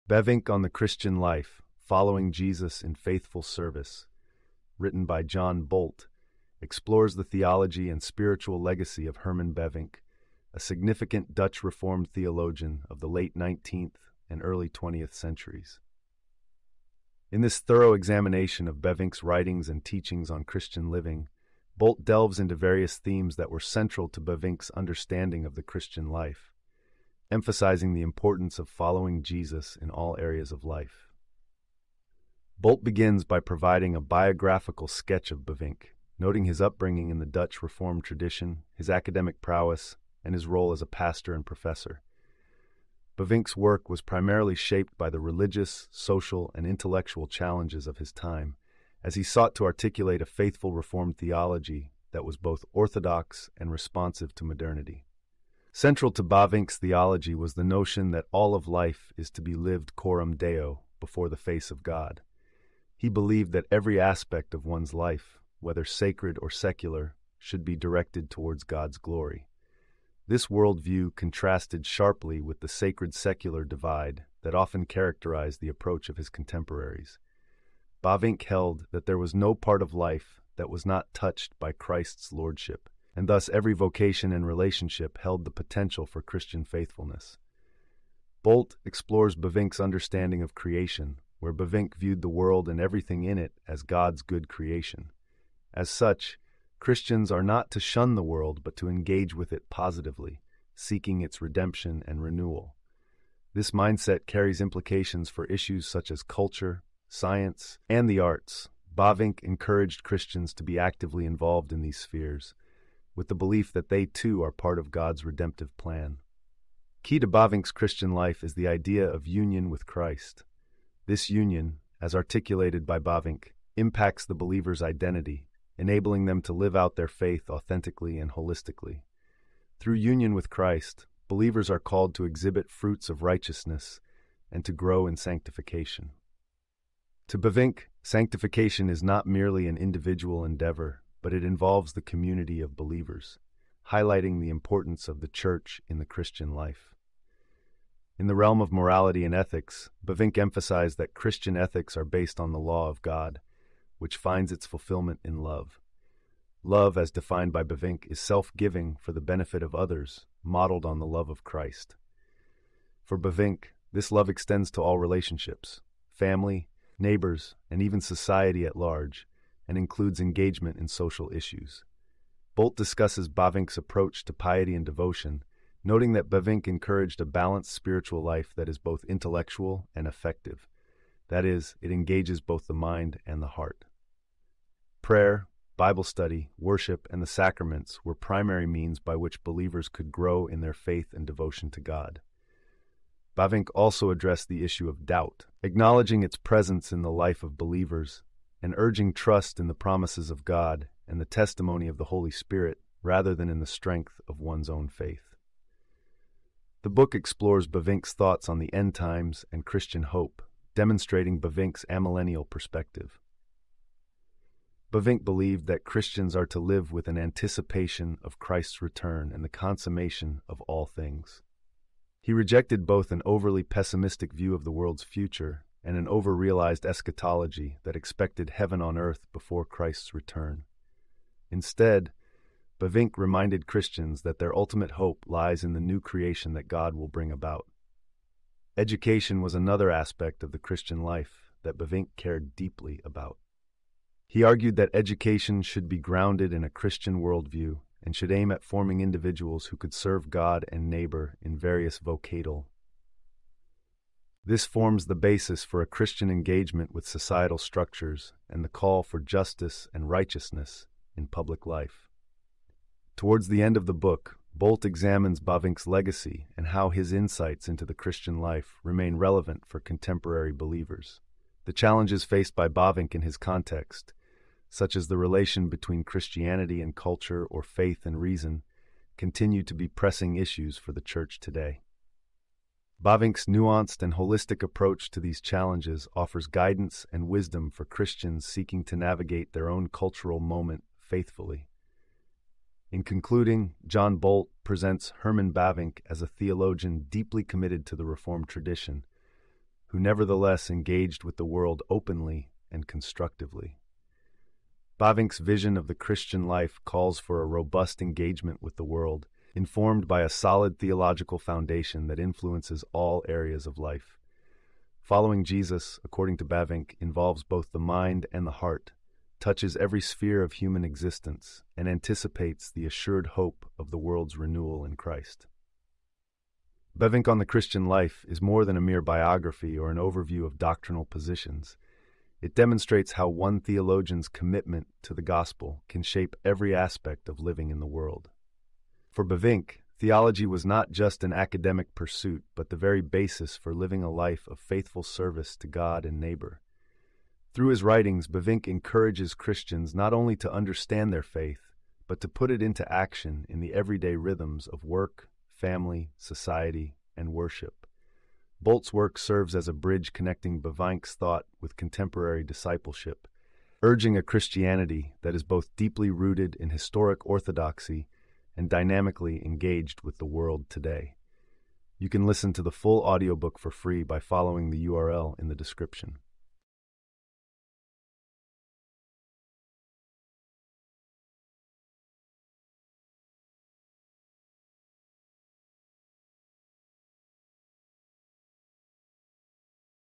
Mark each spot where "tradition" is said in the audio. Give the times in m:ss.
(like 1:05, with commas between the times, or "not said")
0:38, 4:58.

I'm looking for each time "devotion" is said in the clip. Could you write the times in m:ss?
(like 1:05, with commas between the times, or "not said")
2:54, 3:11.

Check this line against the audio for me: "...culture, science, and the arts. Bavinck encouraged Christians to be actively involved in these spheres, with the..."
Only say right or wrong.
right.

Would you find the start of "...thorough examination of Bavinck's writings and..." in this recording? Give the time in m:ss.
0:17.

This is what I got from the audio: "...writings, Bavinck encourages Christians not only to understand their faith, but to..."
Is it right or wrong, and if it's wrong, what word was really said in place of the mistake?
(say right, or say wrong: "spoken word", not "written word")
right.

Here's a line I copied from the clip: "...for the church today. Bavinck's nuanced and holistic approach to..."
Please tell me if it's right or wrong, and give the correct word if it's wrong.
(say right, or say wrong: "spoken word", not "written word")
right.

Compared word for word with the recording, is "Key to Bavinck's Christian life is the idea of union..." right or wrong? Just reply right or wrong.
right.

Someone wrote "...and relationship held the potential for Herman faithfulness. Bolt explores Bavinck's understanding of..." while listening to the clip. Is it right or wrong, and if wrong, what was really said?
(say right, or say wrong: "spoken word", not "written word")
wrong: "Christian", not "Herman".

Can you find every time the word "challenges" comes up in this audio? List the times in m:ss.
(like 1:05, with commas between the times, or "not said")
0:47, 4:31, 4:45.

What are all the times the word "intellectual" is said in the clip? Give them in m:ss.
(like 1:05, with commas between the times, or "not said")
0:46, 2:59.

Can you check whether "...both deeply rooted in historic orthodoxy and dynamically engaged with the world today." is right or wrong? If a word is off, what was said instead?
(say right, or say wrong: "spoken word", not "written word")
right.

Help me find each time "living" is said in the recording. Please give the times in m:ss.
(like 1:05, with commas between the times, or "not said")
0:20, 5:37, 5:43.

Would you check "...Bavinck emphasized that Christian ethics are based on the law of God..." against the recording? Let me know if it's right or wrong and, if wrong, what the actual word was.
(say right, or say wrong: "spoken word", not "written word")
right.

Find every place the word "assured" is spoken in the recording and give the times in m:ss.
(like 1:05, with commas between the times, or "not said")
5:22.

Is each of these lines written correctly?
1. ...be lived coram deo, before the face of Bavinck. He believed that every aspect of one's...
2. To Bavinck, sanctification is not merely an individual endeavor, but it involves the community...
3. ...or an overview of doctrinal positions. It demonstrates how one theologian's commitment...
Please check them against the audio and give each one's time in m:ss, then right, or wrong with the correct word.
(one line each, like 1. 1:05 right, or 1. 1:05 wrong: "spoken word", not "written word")
1. 0:59 wrong: "God", not "Bavinck"
2. 2:17 right
3. 5:29 right.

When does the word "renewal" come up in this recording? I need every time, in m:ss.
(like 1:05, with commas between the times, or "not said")
1:42, 5:24.